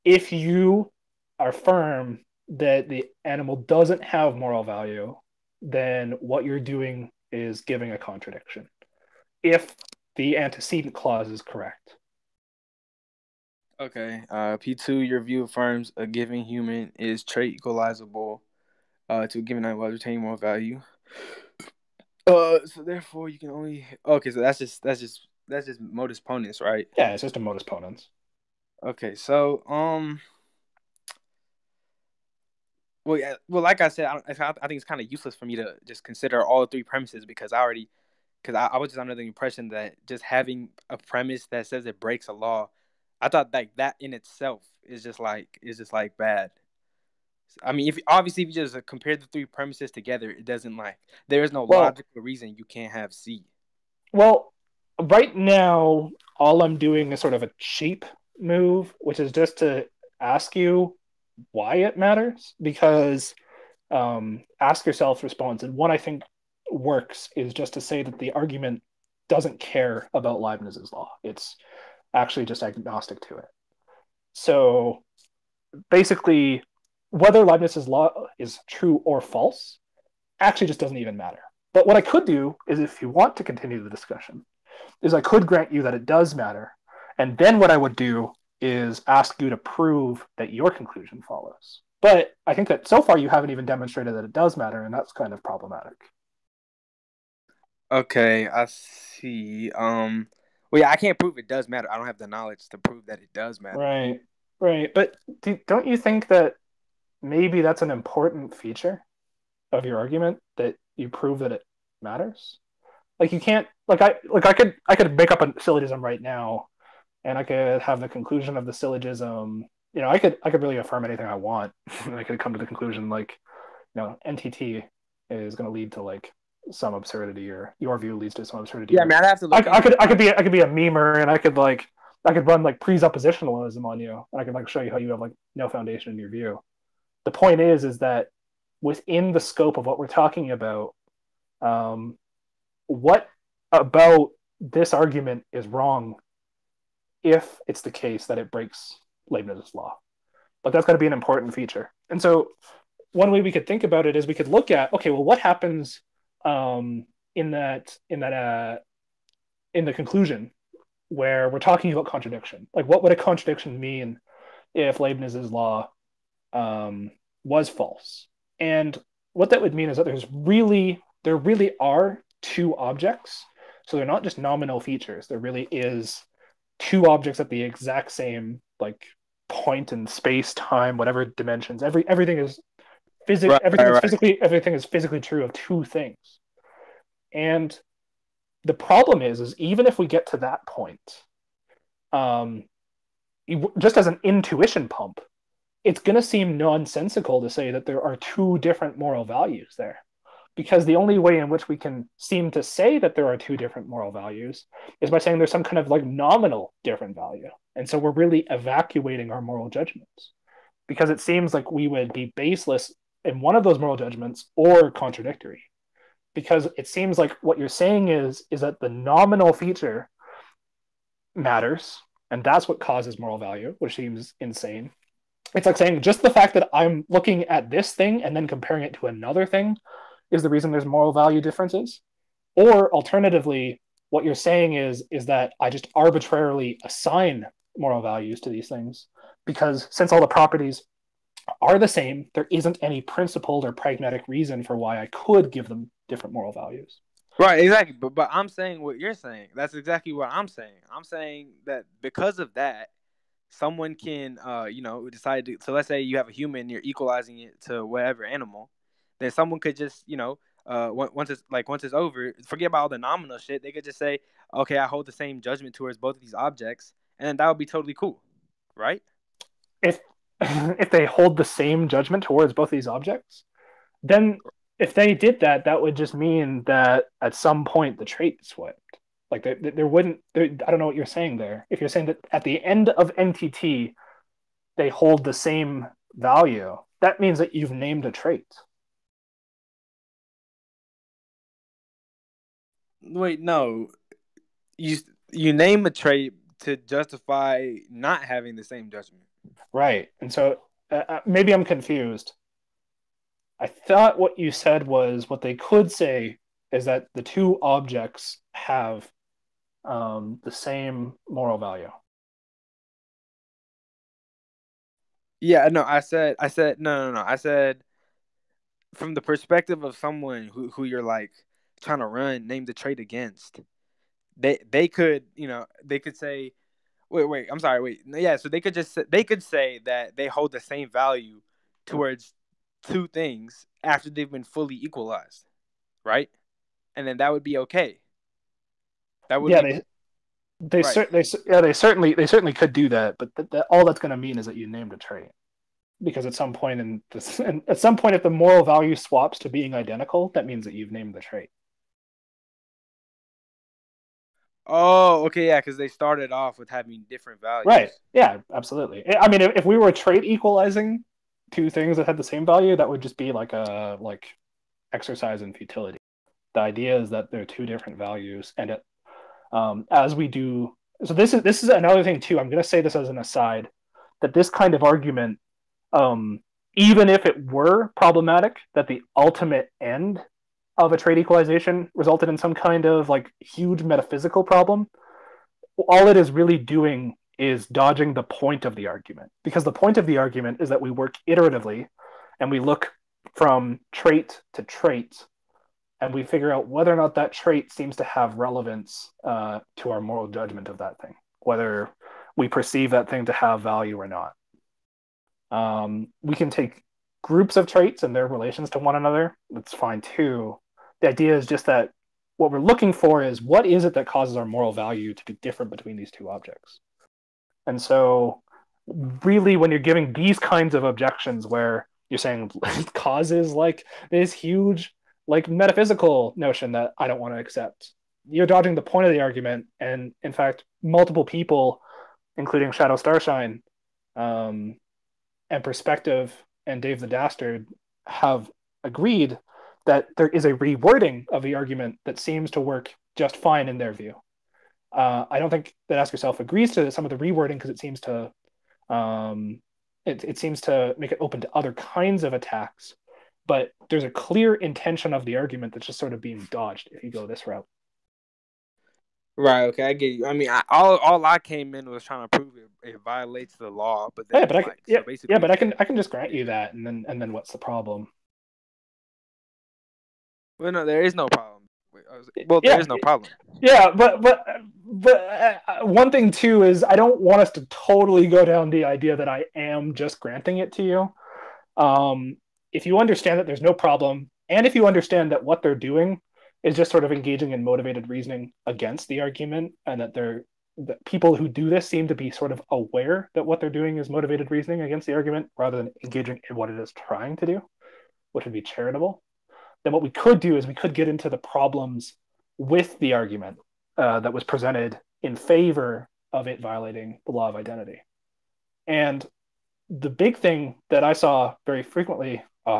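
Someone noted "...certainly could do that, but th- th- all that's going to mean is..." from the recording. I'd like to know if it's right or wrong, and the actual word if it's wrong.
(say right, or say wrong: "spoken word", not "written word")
right.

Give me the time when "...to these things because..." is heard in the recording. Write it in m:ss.
3:58.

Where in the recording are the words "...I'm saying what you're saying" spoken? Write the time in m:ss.
4:08.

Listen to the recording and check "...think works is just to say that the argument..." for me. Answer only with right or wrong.
right.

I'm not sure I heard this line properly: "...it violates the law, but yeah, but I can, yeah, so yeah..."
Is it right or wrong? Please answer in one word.
right.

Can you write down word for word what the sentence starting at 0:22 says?
Uh, so therefore, you can only okay.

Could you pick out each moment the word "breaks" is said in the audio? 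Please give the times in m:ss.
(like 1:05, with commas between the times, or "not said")
0:41, 2:28.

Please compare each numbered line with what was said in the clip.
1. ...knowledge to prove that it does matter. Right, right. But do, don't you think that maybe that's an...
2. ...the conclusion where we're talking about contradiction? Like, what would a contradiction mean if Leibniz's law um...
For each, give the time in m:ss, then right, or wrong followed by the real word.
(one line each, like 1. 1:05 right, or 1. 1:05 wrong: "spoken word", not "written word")
1. 1:42 right
2. 2:39 right.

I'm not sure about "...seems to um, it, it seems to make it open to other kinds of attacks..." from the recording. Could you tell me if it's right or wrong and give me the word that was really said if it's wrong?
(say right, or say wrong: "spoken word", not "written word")
right.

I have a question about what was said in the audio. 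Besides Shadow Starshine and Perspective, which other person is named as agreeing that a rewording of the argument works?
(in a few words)
Dave the Dastard.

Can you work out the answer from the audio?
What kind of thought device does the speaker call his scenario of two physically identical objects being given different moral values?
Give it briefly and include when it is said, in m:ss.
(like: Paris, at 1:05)
intuition pump, at 3:14.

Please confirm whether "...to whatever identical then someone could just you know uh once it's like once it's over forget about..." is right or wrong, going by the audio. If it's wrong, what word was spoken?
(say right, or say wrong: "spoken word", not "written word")
wrong: "animal", not "identical".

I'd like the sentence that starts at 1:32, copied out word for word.
But I think that so far you haven't even demonstrated that it does matter, and that's kind of problematic.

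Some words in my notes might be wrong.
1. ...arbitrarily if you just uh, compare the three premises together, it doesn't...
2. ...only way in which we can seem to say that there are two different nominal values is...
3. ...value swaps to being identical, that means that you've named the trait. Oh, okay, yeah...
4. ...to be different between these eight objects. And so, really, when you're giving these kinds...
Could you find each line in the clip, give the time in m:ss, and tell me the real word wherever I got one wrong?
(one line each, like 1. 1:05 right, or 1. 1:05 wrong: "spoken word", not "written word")
1. 0:48 wrong: "obviously", not "arbitrarily"
2. 3:20 wrong: "moral", not "nominal"
3. 5:48 right
4. 6:55 wrong: "two", not "eight".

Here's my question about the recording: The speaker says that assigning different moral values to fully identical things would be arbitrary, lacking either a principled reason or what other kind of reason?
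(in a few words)
pragmatic.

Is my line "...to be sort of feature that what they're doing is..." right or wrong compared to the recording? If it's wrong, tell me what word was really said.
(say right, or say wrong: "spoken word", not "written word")
wrong: "aware", not "feature".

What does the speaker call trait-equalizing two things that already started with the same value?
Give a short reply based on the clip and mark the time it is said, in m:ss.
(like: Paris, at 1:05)
exercise in futility, at 6:04.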